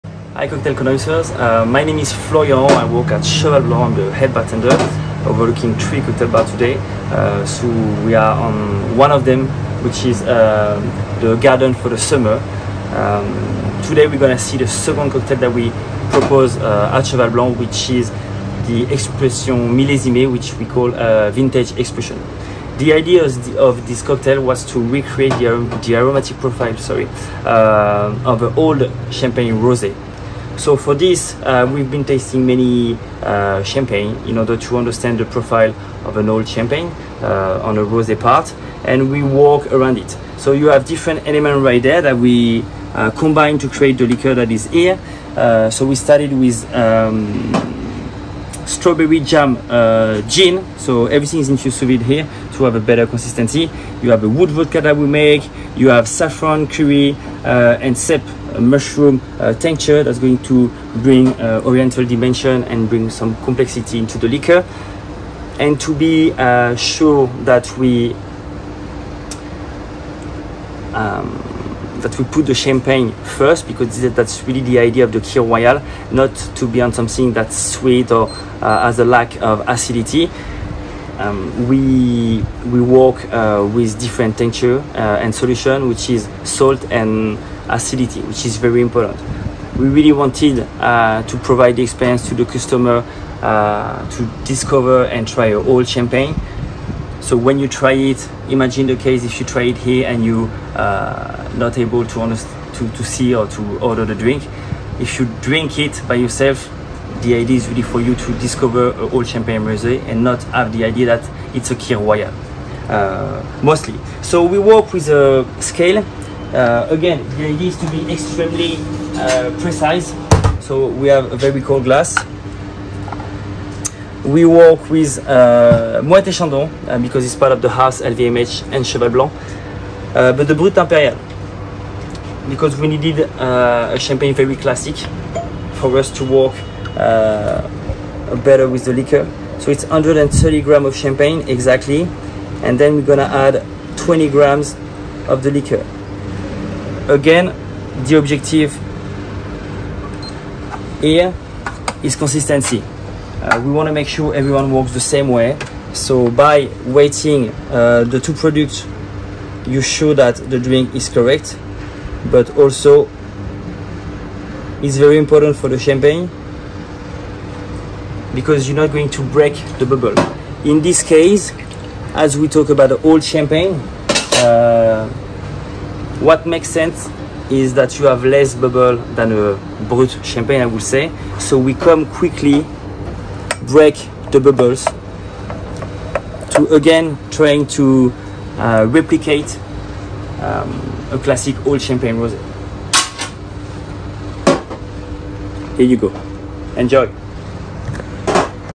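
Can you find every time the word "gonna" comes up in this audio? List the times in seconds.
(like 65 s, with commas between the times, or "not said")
14 s, 143 s.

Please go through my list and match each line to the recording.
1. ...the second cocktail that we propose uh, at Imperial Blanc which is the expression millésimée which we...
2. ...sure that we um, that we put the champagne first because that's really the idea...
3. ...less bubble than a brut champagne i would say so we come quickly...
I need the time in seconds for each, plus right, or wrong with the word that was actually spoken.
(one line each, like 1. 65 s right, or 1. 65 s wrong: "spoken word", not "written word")
1. 14 s wrong: "Cheval", not "Imperial"
2. 66 s right
3. 178 s right.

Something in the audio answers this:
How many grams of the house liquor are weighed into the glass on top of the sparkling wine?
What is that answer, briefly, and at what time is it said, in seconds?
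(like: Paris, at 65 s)
20 grams, at 143 s.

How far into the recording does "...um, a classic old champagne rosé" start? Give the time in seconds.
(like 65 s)
190 s.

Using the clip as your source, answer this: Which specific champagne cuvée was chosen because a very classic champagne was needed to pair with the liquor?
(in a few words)
Brut Imperial.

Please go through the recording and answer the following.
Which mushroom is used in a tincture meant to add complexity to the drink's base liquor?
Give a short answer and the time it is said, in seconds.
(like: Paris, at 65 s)
cèpe, at 57 s.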